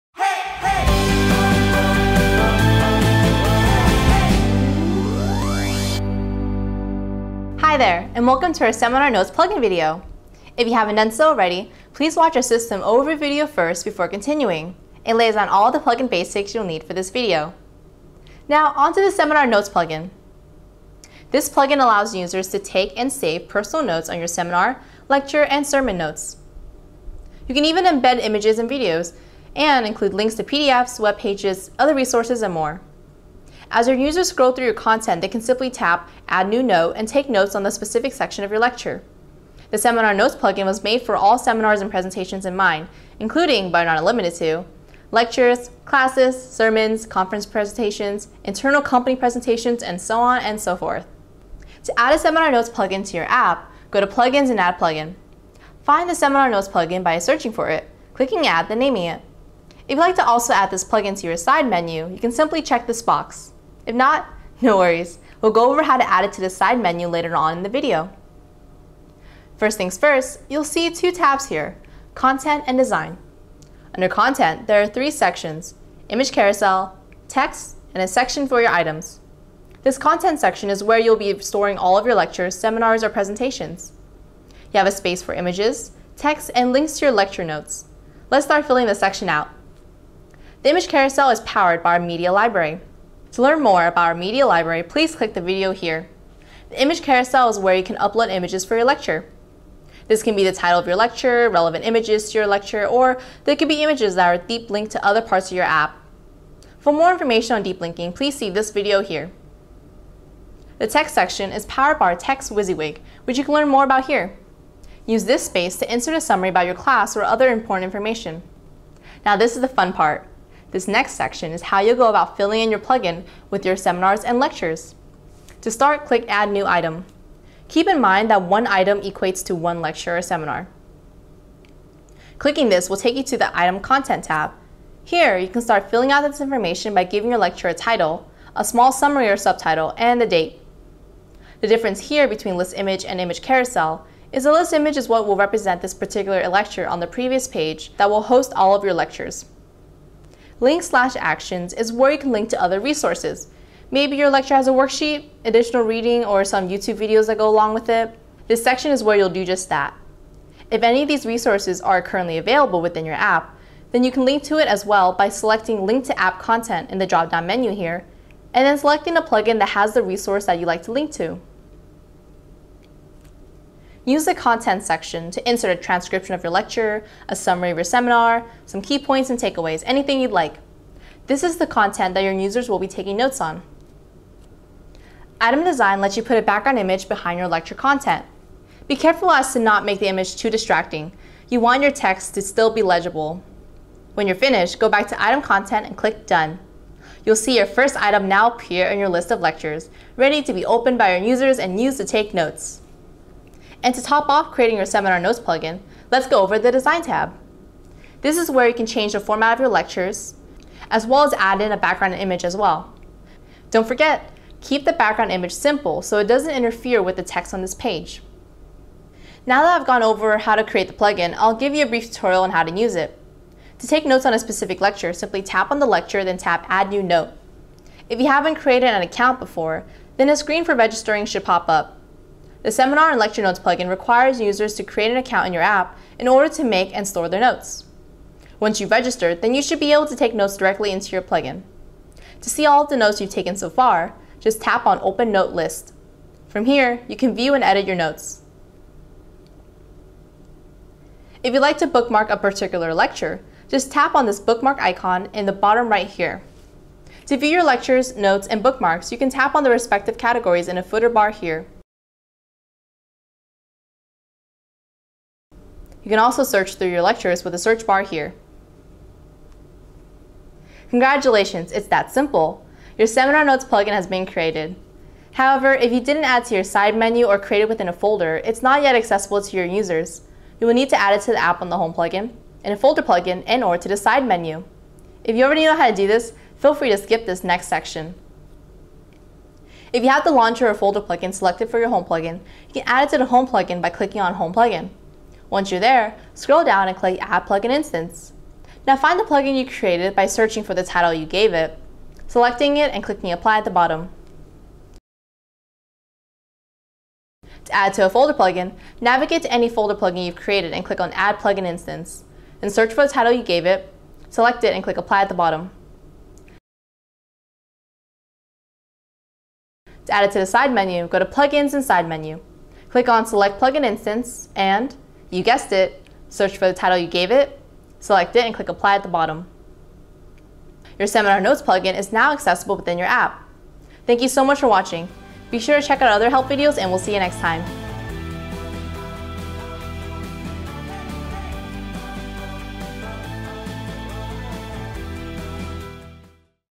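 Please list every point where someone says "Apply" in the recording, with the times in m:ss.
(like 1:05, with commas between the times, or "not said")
5:03, 5:14, 5:28.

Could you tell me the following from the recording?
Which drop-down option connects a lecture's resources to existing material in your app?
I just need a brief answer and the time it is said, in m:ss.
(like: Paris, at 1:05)
Link to App Content, at 2:45.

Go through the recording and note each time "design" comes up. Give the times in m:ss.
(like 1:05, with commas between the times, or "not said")
1:12, 3:05, 3:26.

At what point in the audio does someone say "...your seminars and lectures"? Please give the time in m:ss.
2:03.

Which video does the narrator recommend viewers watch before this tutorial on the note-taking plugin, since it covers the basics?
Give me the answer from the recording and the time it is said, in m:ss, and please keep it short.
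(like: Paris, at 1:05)
System overview video, at 0:12.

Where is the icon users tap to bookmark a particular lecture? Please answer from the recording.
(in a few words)
Bottom right.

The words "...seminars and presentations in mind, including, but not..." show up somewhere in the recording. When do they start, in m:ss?
0:41.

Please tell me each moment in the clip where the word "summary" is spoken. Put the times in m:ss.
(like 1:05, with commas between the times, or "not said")
1:56, 2:18, 2:57.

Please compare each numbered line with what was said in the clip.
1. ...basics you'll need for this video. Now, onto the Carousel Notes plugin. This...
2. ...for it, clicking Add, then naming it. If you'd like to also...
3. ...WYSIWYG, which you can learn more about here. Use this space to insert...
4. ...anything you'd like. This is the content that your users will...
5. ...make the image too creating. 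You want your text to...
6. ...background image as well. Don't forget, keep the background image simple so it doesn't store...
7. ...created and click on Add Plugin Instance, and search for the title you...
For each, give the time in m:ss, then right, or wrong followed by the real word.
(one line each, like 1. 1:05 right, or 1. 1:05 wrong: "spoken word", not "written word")
1. 0:16 wrong: "Seminar", not "Carousel"
2. 0:57 right
3. 1:52 right
4. 2:59 right
5. 3:09 wrong: "distracting", not "creating"
6. 3:31 wrong: "interfere", not "store"
7. 5:10 right.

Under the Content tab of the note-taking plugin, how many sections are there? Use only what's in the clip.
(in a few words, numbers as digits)
3.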